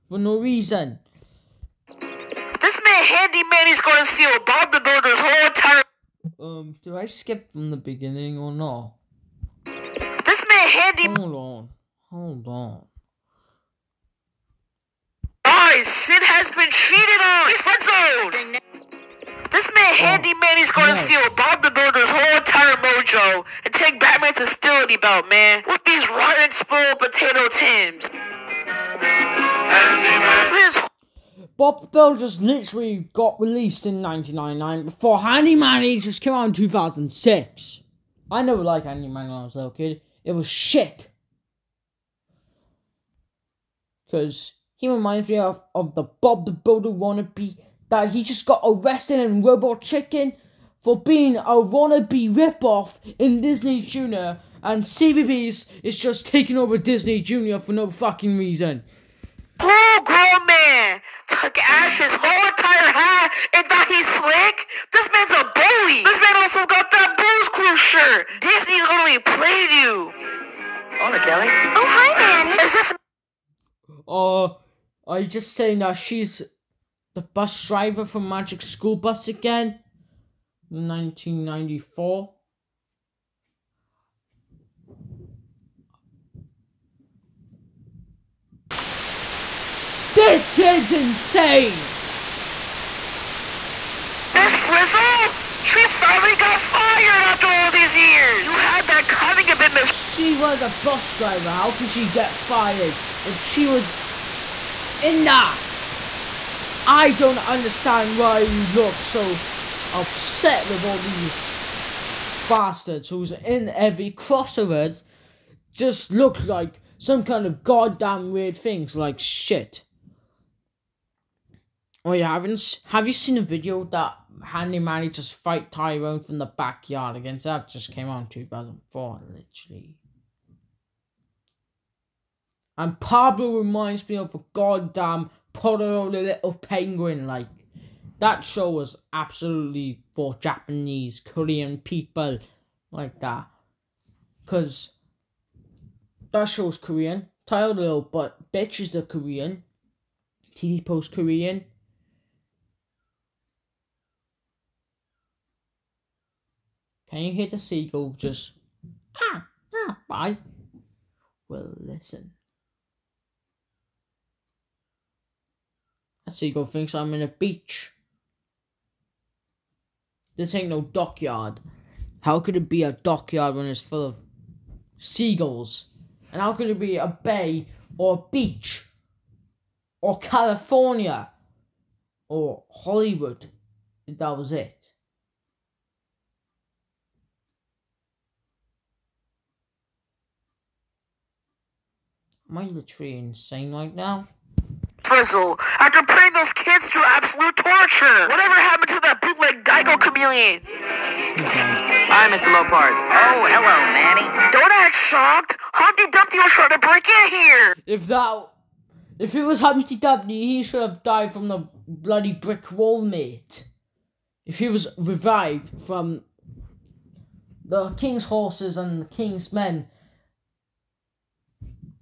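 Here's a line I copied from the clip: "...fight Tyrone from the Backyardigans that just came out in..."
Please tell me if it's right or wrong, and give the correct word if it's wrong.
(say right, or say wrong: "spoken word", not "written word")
right.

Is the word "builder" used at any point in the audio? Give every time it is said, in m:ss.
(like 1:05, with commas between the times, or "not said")
0:04, 0:21, 0:31, 0:46.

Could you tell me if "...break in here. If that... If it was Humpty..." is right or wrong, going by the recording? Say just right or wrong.
right.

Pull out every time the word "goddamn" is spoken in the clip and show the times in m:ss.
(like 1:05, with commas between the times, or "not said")
1:57, 2:14.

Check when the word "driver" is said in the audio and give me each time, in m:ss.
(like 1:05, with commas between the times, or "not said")
1:17, 1:41.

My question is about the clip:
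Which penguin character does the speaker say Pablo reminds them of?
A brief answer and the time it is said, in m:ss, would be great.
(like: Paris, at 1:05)
Pororo the Little Penguin, at 2:15.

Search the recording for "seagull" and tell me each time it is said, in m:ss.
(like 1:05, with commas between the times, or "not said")
2:37, 2:46, 2:54.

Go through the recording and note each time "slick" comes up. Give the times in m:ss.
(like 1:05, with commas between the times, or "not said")
1:04.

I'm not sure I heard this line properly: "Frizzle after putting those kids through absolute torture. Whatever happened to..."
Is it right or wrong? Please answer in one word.
right.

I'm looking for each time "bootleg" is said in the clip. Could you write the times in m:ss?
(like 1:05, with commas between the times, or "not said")
3:19.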